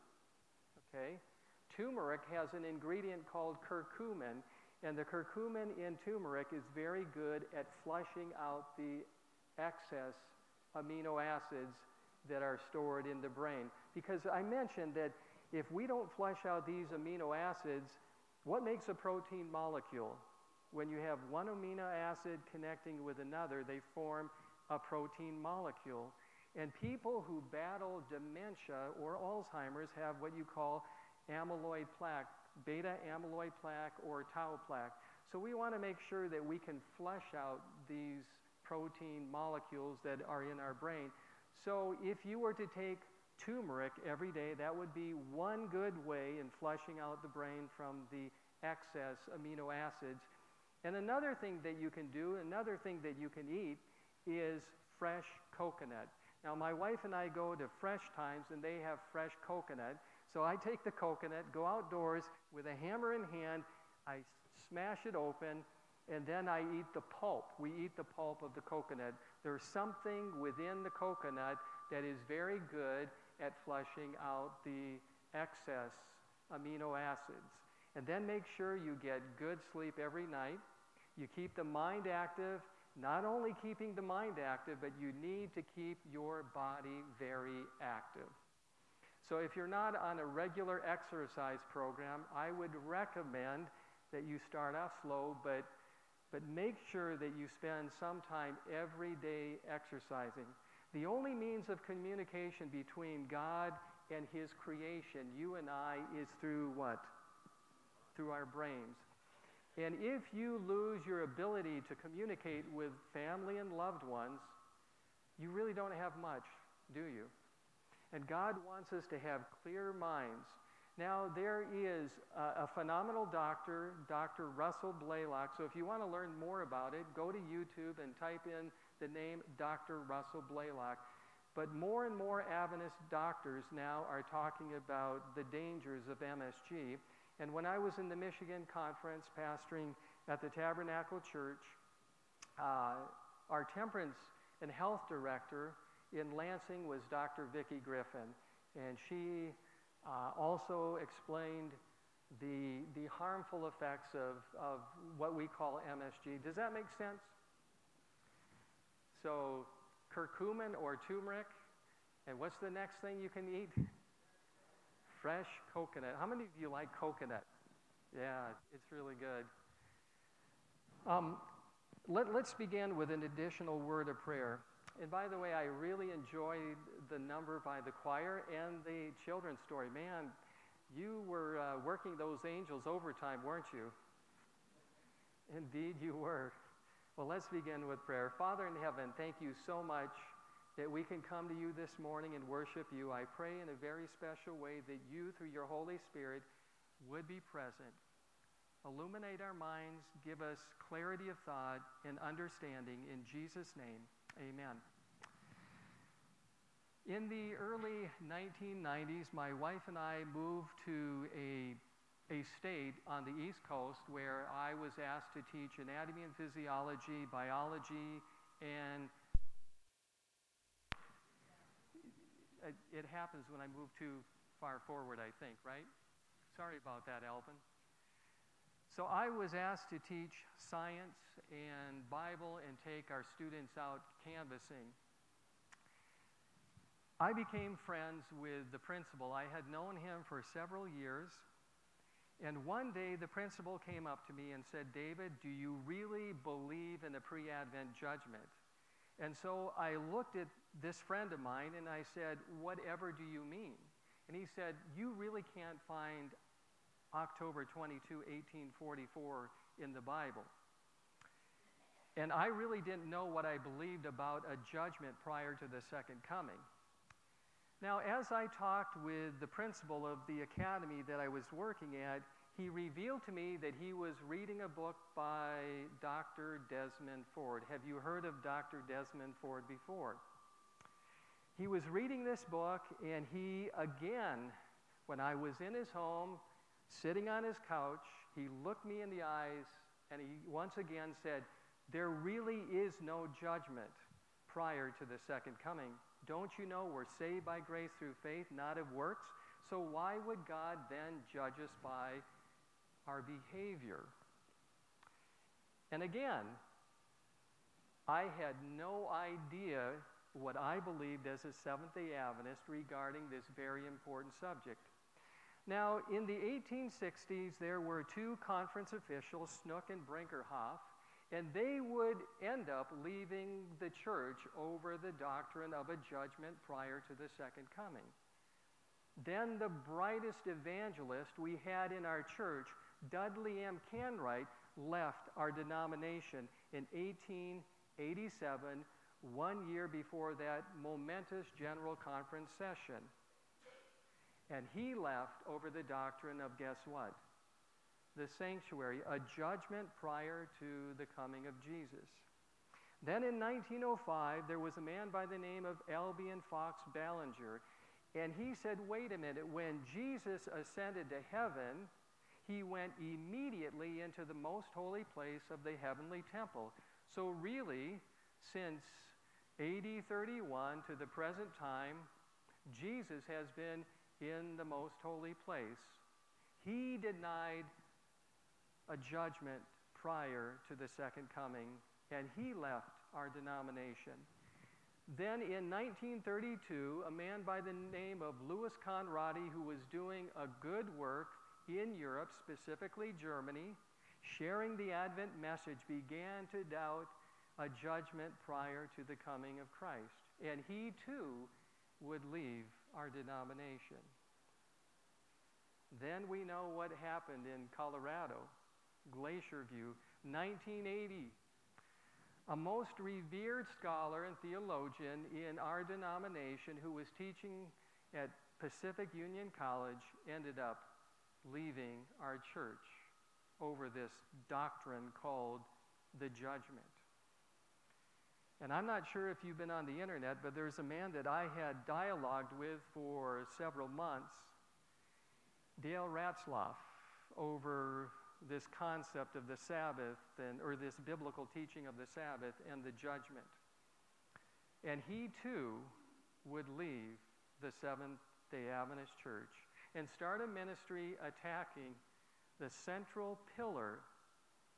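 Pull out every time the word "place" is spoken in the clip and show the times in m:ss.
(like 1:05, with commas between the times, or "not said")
6:05, 6:15.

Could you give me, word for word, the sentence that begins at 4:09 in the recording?
And so I looked at this friend of mine and I said, Whatever do you mean?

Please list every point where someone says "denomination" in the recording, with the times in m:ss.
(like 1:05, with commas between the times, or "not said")
5:35, 6:23, 6:43, 6:55.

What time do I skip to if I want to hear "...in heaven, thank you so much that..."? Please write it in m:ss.
3:08.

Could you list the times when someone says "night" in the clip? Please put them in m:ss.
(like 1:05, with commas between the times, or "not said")
1:20.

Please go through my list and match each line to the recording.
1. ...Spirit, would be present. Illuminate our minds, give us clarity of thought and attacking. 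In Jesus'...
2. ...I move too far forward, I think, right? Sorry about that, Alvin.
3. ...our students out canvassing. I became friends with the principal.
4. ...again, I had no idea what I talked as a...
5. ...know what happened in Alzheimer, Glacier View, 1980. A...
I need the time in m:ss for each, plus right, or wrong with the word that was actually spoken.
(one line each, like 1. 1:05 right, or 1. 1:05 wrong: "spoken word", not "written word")
1. 3:16 wrong: "understanding", not "attacking"
2. 3:43 right
3. 3:53 right
4. 5:06 wrong: "believed", not "talked"
5. 6:46 wrong: "Colorado", not "Alzheimer".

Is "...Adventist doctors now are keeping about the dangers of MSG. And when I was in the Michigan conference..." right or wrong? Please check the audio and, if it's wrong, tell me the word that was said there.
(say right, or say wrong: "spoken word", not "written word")
wrong: "talking", not "keeping".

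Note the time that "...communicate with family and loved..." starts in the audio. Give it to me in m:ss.
1:52.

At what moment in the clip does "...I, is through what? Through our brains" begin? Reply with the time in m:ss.
1:45.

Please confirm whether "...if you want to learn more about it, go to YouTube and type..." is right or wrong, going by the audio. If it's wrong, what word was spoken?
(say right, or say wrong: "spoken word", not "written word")
right.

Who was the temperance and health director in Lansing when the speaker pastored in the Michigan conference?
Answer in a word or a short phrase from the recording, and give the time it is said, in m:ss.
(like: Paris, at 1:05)
Dr. Vicki Griffin, at 2:27.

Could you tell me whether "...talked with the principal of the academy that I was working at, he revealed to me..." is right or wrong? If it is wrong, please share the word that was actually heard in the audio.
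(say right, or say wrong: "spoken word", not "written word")
right.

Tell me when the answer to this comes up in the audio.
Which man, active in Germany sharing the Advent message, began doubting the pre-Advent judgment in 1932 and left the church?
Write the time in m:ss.
6:28.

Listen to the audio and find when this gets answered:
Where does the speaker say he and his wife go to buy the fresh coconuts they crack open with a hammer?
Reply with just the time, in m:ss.
0:57.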